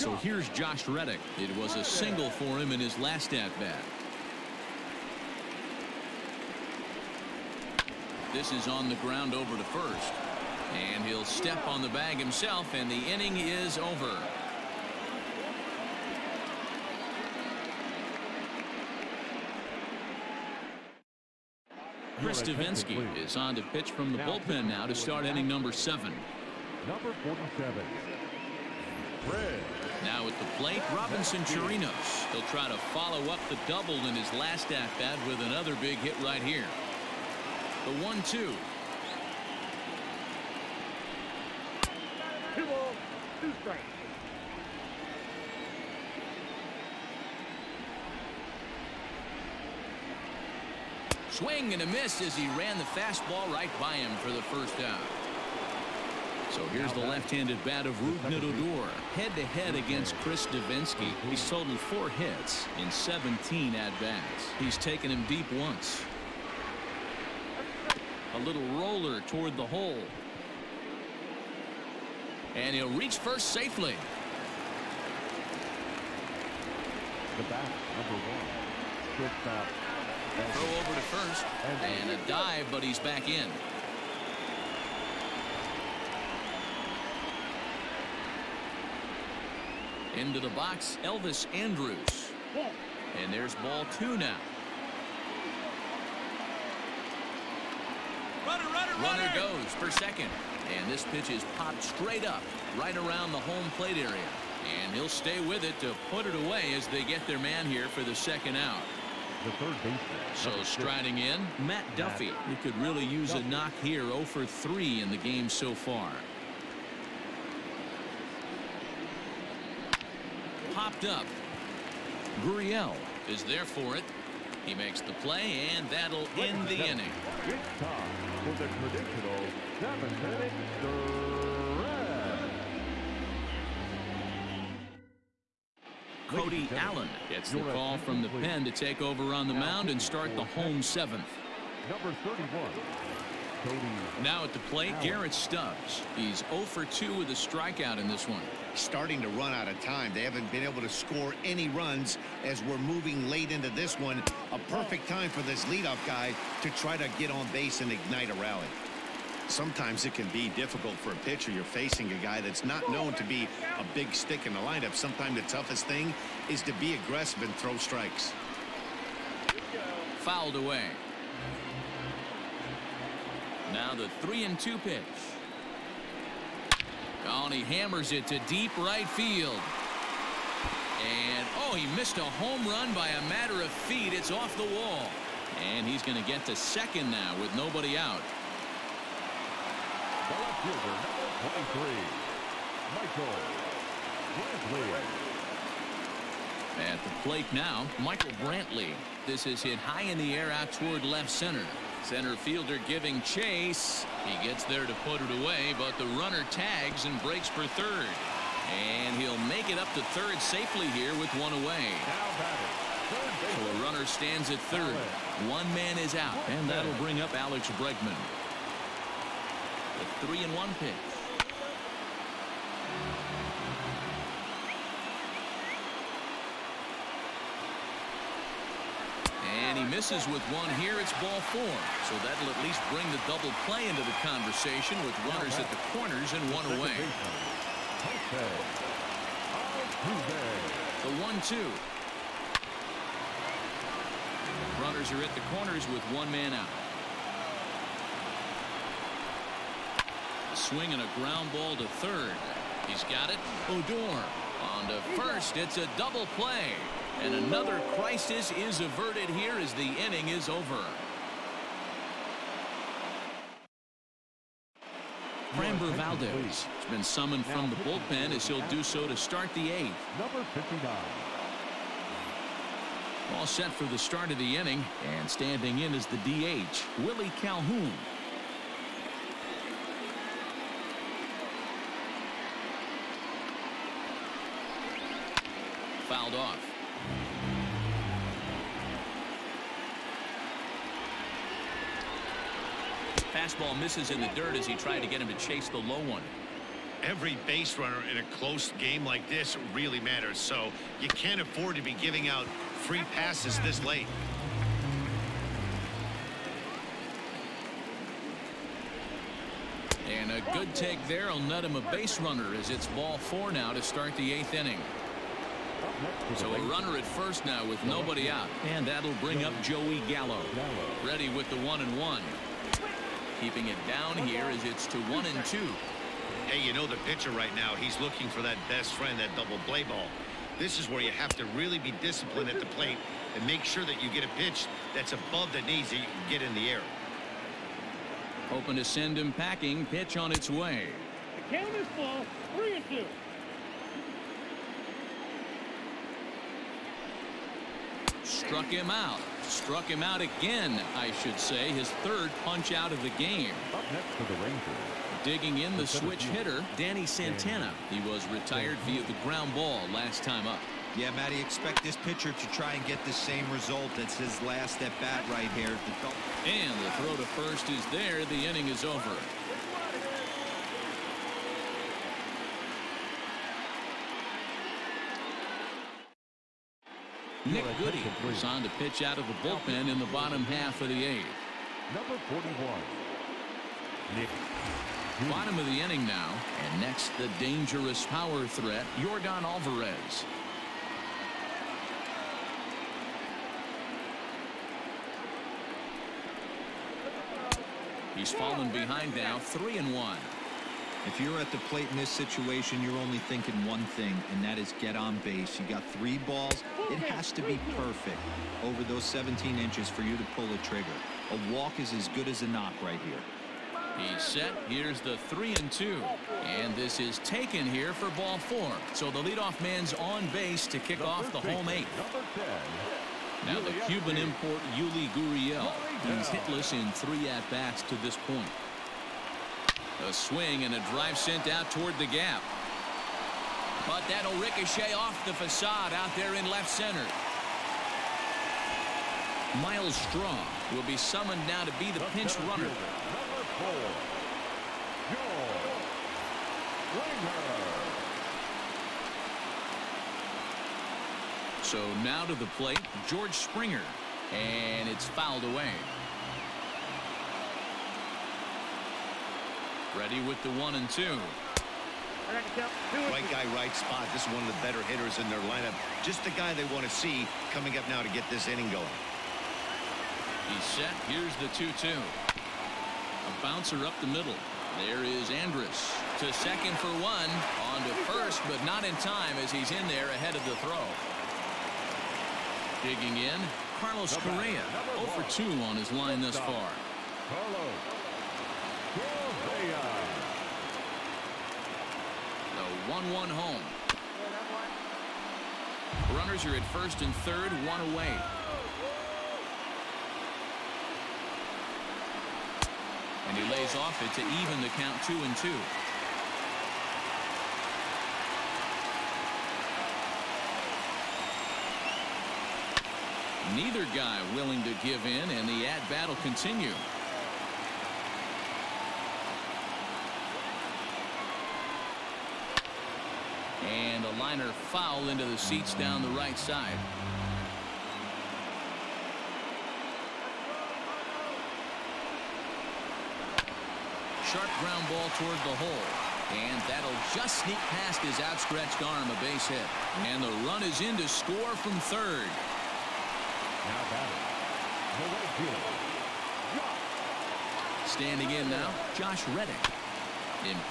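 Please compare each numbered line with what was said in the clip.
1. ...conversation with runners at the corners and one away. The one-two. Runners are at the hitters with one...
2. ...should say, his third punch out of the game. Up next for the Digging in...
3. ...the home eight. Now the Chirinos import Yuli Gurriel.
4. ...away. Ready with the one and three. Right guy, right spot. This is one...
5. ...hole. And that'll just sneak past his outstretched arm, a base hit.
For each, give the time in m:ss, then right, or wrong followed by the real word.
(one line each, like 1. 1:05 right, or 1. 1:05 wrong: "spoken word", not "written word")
1. 3:54 wrong: "corners", not "hitters"
2. 5:51 right
3. 7:01 wrong: "Cuban", not "Chirinos"
4. 7:35 wrong: "two", not "three"
5. 8:55 right.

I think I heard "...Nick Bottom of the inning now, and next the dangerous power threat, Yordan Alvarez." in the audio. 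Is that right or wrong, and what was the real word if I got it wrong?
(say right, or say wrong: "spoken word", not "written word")
right.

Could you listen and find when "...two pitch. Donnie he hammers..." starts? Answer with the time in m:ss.
2:54.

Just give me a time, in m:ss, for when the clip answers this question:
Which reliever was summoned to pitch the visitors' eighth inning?
4:25.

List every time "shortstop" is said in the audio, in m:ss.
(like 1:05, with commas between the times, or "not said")
1:19.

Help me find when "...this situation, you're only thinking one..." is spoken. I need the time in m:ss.
6:41.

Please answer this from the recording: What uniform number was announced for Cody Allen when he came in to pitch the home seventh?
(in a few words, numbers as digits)
31.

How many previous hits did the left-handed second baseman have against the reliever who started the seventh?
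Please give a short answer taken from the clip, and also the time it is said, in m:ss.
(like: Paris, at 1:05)
4, at 1:01.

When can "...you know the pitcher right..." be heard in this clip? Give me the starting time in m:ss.
5:26.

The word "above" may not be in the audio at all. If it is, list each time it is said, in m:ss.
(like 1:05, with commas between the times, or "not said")
5:35.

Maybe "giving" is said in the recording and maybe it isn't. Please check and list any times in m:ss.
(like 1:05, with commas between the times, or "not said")
3:22, 5:02.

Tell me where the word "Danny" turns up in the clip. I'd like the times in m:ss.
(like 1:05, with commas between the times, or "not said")
5:56.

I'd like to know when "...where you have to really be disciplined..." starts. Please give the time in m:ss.
5:30.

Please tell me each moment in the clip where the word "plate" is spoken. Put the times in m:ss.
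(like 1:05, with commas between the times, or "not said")
0:30, 1:43, 2:24, 3:17, 5:32, 6:41, 7:32.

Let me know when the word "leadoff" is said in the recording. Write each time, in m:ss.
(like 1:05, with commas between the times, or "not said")
2:35, 6:59.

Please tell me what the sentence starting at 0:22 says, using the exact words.
Chris Davinsky is on to pitch from the bullpen now to start inning number seven.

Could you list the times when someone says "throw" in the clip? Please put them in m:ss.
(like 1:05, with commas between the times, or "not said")
1:20, 2:47, 6:06, 8:00.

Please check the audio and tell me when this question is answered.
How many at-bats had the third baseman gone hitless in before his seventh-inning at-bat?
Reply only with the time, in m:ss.
1:54.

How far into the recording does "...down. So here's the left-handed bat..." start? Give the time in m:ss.
0:54.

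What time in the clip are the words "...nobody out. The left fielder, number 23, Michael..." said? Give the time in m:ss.
3:07.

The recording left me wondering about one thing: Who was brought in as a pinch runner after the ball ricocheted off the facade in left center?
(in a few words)
Myles Straw.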